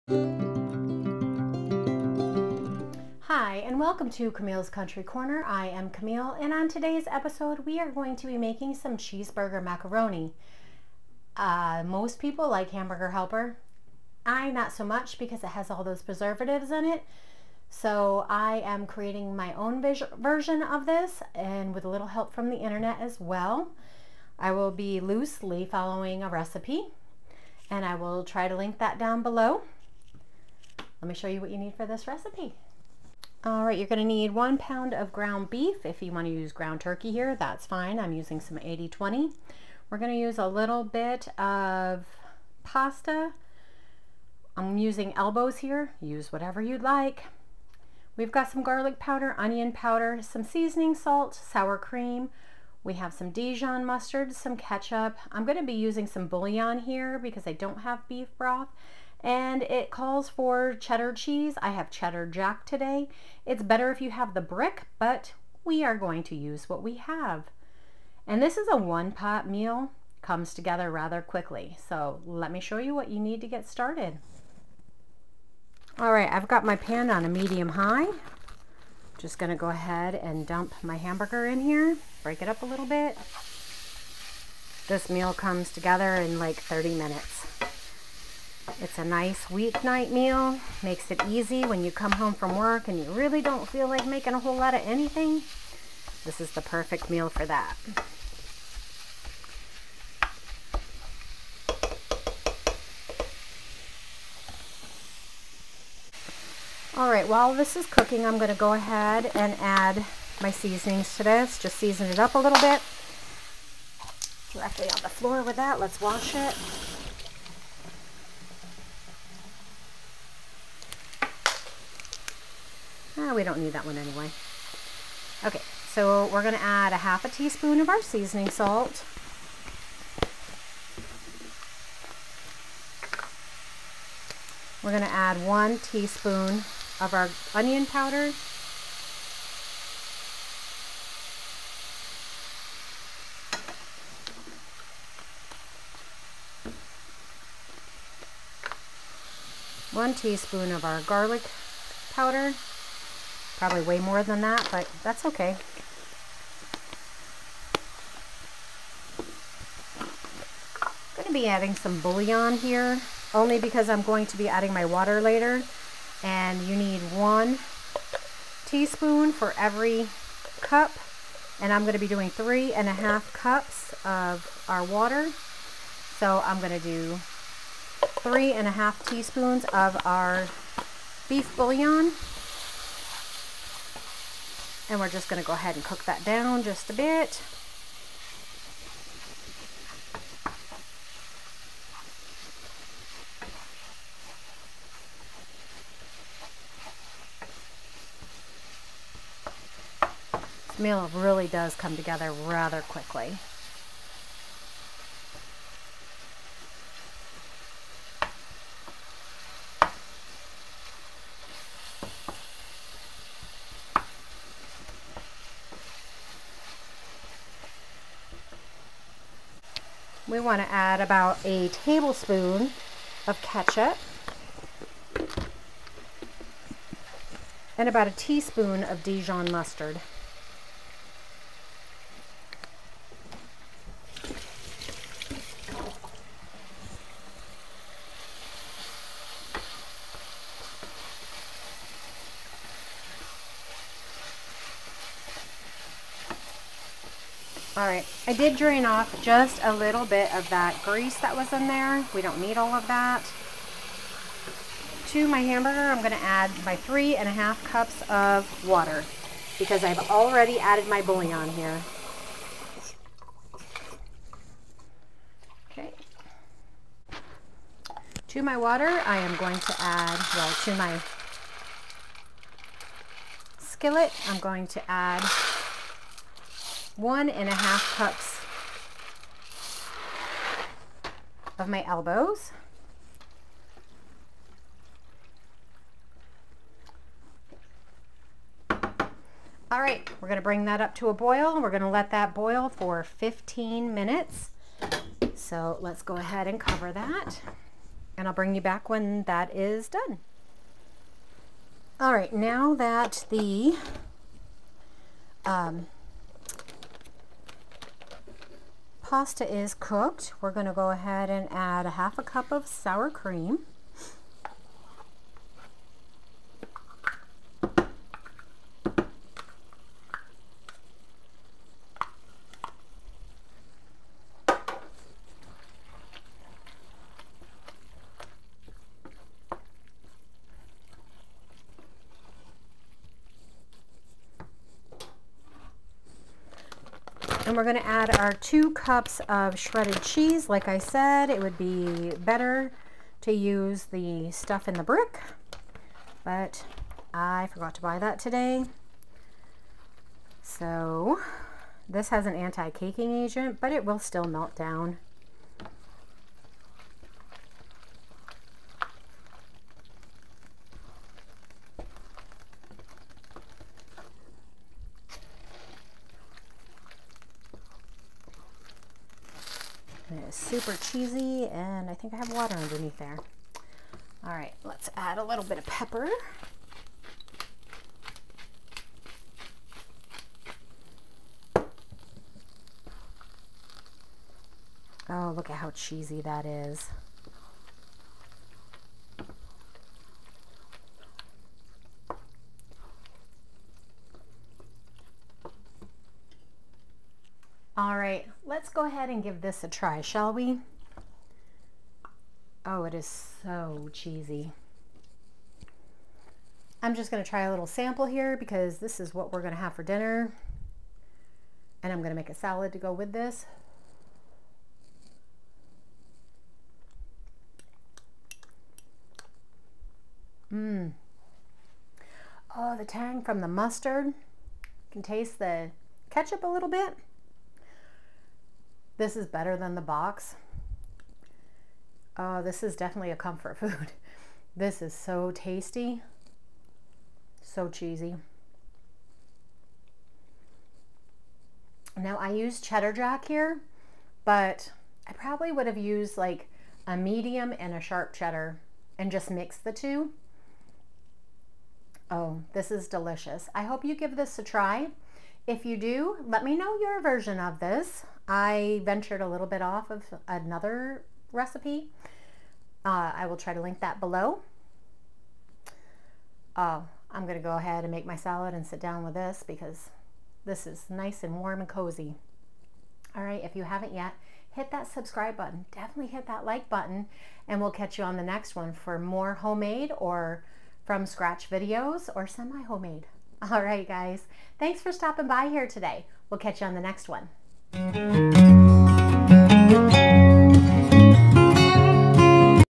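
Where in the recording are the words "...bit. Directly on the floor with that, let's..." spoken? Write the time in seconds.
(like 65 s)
112 s.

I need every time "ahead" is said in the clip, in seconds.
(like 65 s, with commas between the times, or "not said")
79 s, 108 s, 185 s, 296 s, 310 s, 398 s, 467 s.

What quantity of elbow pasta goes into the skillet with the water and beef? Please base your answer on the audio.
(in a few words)
1.5 cups.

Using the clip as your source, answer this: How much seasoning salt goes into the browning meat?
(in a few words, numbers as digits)
half a teaspoon.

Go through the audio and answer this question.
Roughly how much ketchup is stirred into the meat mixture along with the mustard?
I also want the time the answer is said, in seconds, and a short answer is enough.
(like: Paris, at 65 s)
1 tablespoon, at 221 s.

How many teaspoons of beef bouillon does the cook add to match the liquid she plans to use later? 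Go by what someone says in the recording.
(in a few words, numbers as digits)
3.5 teaspoons.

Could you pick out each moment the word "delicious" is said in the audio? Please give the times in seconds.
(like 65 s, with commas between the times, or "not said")
452 s.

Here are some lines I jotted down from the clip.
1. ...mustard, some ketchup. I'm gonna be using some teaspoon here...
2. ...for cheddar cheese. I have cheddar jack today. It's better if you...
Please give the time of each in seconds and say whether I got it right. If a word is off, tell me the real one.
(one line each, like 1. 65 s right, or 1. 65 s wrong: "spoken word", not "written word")
1. 53 s wrong: "bouillon", not "teaspoon"
2. 60 s right.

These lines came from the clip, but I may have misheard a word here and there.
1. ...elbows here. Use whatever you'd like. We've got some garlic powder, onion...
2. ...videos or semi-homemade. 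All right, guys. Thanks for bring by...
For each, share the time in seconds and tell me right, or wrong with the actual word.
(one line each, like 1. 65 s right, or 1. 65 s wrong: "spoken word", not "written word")
1. 45 s right
2. 481 s wrong: "stopping", not "bring".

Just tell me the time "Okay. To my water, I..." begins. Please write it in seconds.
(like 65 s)
265 s.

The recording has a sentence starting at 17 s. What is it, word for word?
So I am creating my own version of this and with a little help from the internet as well.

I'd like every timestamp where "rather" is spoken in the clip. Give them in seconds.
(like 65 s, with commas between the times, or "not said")
70 s, 202 s.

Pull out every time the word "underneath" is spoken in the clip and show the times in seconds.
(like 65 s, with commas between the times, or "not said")
372 s.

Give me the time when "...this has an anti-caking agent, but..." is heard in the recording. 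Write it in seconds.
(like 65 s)
351 s.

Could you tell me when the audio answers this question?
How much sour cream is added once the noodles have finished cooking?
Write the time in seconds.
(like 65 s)
311 s.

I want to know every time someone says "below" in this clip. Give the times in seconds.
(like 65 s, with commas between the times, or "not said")
29 s, 463 s.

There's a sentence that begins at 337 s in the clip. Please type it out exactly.
And we're going to add our two cups of shredded cheese.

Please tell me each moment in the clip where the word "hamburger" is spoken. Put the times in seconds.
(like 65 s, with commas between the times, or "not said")
12 s, 80 s, 255 s.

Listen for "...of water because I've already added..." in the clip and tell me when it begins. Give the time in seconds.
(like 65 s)
258 s.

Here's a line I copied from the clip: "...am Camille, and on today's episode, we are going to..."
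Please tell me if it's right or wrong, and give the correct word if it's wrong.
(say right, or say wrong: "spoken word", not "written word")
right.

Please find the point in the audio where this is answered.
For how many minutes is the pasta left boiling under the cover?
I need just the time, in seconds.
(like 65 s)
293 s.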